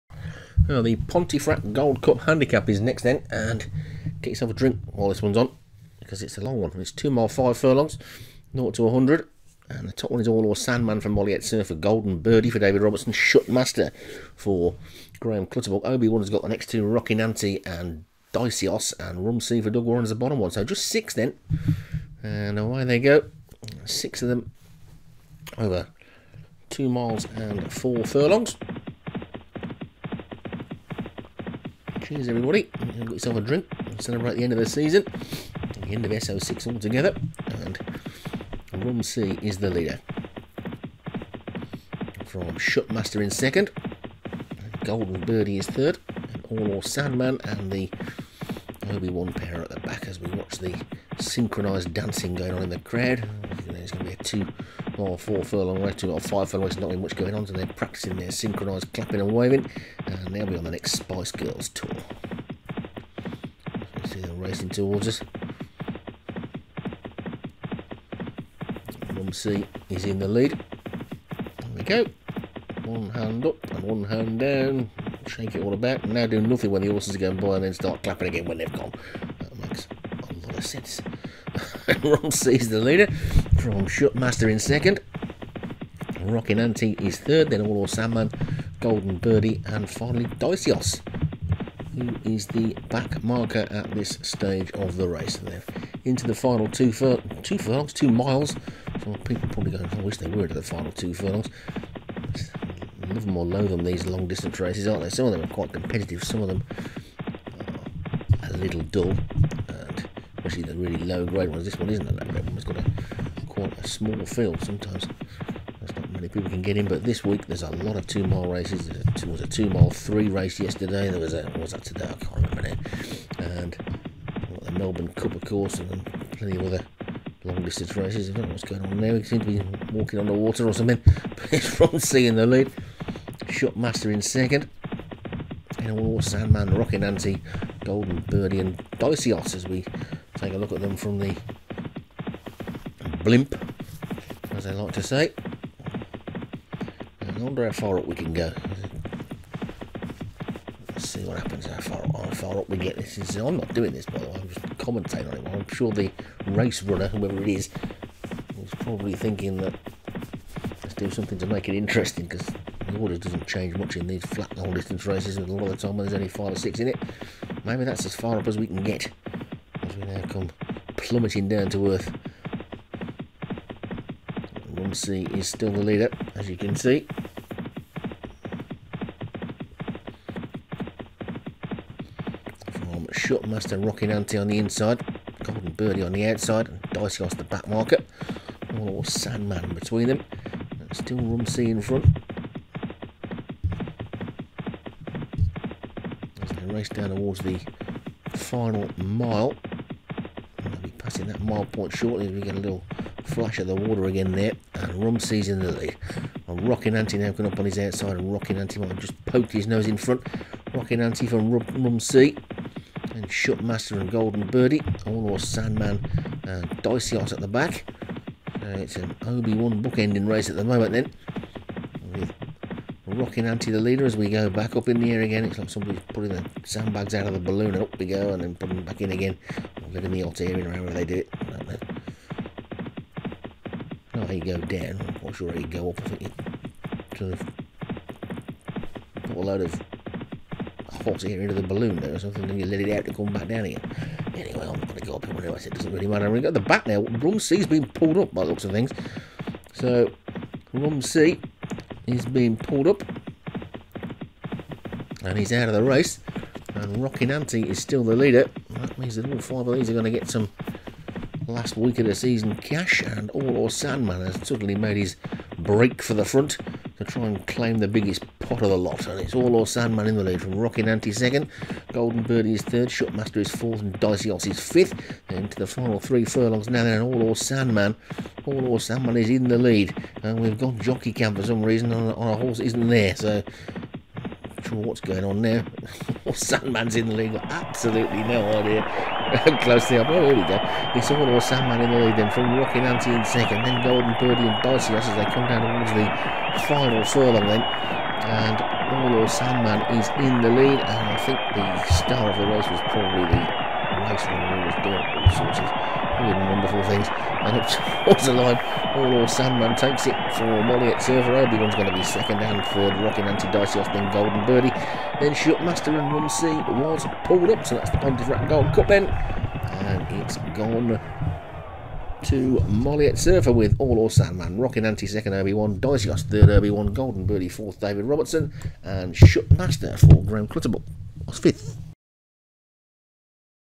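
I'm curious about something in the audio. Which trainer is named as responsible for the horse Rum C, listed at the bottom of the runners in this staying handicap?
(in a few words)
Doug Warren.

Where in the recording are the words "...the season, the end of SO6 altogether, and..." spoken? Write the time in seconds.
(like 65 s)
34 s.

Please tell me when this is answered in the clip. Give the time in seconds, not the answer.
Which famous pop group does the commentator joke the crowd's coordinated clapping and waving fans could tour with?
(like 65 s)
60 s.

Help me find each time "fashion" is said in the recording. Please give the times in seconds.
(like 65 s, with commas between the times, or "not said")
not said.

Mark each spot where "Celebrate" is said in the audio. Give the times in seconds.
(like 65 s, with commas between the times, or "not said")
33 s.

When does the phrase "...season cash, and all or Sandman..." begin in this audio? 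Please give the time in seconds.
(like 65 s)
262 s.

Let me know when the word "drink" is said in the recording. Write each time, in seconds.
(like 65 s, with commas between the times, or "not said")
4 s, 33 s.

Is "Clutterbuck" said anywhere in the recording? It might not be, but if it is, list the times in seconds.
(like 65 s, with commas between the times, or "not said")
15 s, 330 s.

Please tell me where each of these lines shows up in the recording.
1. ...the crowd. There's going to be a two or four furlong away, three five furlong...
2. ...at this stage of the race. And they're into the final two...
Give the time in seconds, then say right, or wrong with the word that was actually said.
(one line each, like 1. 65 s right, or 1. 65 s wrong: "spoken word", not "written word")
1. 52 s wrong: "two", not "three"
2. 93 s right.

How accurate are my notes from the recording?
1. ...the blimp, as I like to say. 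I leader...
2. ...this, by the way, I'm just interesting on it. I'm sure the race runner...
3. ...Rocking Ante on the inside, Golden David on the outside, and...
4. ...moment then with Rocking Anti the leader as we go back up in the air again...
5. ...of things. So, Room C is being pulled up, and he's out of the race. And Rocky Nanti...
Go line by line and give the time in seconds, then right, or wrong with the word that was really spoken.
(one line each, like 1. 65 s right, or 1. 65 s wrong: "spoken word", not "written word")
1. 141 s wrong: "wonder", not "leader"
2. 153 s wrong: "commentating", not "interesting"
3. 183 s wrong: "Birdie", not "David"
4. 220 s right
5. 248 s right.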